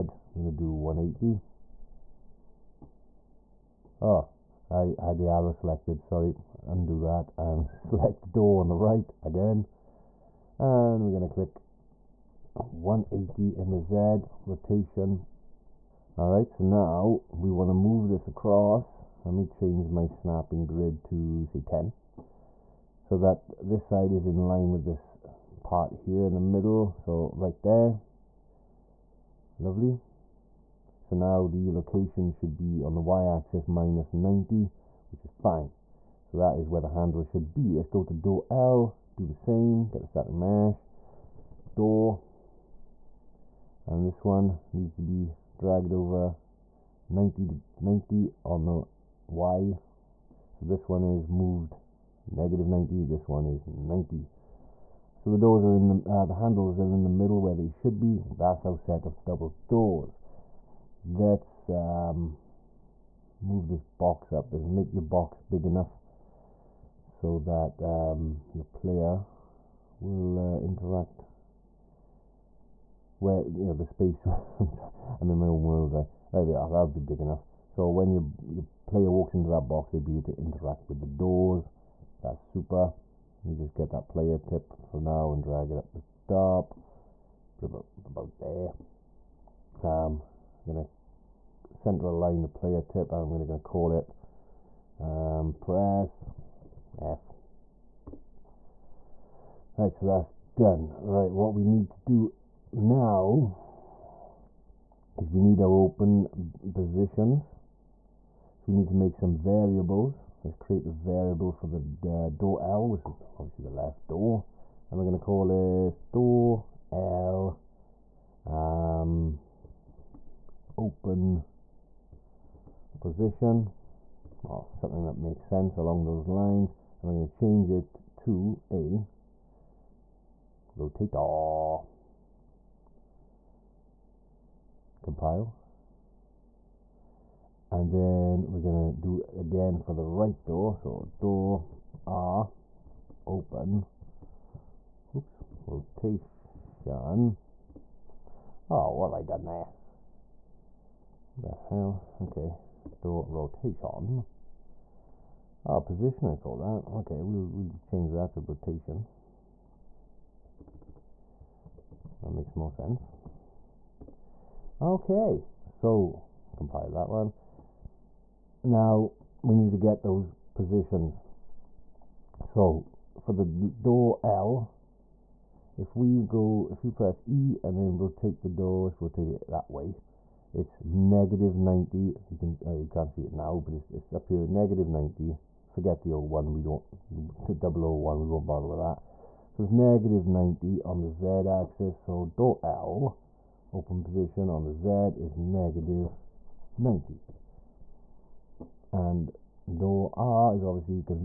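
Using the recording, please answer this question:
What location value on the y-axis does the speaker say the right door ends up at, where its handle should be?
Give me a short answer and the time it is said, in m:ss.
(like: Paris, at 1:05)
-90, at 0:33.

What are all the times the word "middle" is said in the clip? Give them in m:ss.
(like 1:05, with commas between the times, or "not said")
0:26, 0:57.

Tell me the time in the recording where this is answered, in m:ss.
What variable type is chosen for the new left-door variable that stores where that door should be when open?
2:10.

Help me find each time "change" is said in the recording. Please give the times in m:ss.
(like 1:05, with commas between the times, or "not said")
0:19, 2:07, 2:37.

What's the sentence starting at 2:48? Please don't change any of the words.
Now we need to get those positions.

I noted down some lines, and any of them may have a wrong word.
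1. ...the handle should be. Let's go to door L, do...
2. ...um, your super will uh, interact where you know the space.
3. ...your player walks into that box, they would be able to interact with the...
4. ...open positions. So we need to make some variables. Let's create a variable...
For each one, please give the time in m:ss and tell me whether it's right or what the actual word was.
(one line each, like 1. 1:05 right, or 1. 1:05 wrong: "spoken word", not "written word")
1. 0:36 right
2. 1:07 wrong: "player", not "super"
3. 1:18 right
4. 1:45 right.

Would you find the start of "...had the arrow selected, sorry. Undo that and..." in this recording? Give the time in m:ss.
0:04.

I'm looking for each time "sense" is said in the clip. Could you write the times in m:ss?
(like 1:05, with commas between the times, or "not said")
2:05, 2:42.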